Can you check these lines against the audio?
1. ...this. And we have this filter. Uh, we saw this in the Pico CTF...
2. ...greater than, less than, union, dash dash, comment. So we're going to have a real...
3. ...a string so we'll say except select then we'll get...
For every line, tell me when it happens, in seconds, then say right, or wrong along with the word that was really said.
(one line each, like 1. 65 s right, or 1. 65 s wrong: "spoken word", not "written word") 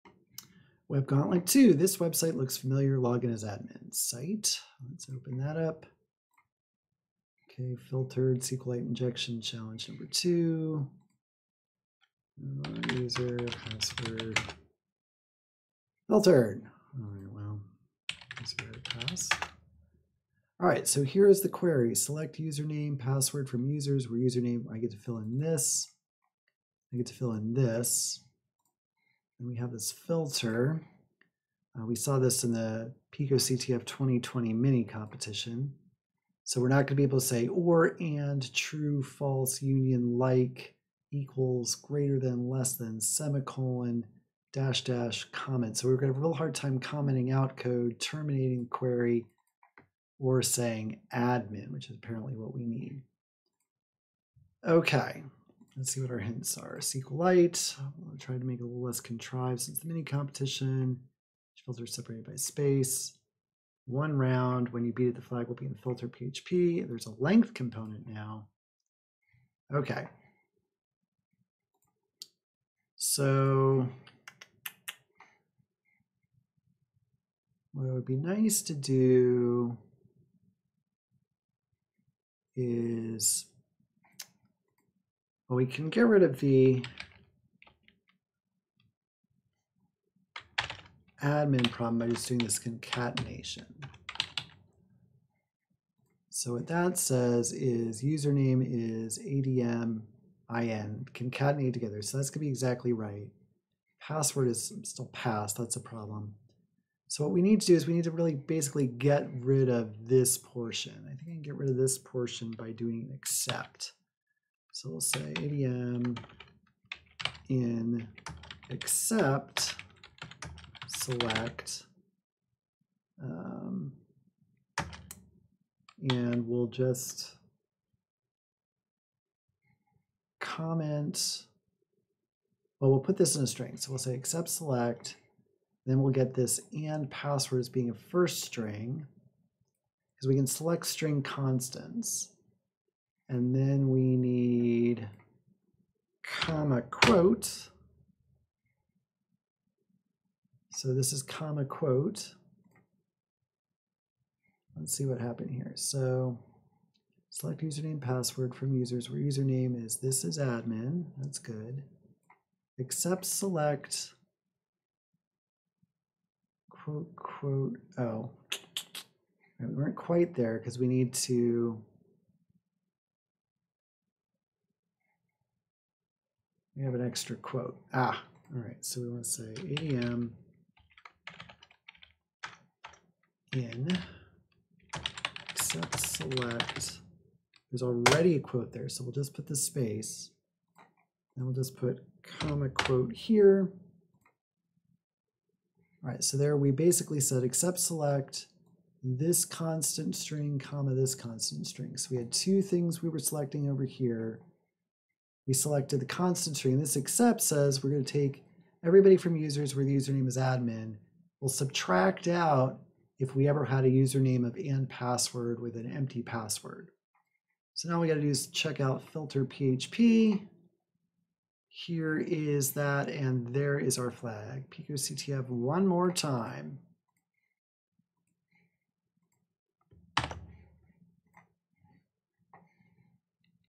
1. 27 s right
2. 41 s wrong: "semicolon", not "union"
3. 133 s right.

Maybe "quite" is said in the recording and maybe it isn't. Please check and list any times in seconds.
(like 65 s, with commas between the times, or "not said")
169 s.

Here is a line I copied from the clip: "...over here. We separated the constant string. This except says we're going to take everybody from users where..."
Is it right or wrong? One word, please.
wrong.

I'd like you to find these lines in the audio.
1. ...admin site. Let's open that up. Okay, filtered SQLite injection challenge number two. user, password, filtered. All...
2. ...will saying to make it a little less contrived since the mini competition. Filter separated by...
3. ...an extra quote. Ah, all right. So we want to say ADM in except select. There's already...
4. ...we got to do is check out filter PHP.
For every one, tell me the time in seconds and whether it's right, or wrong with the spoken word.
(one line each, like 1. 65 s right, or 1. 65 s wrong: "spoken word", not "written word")
1. 3 s right
2. 58 s wrong: "trying", not "saying"
3. 176 s right
4. 217 s right.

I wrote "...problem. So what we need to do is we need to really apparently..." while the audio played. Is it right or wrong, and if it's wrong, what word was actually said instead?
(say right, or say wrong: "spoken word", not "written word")
wrong: "basically", not "apparently".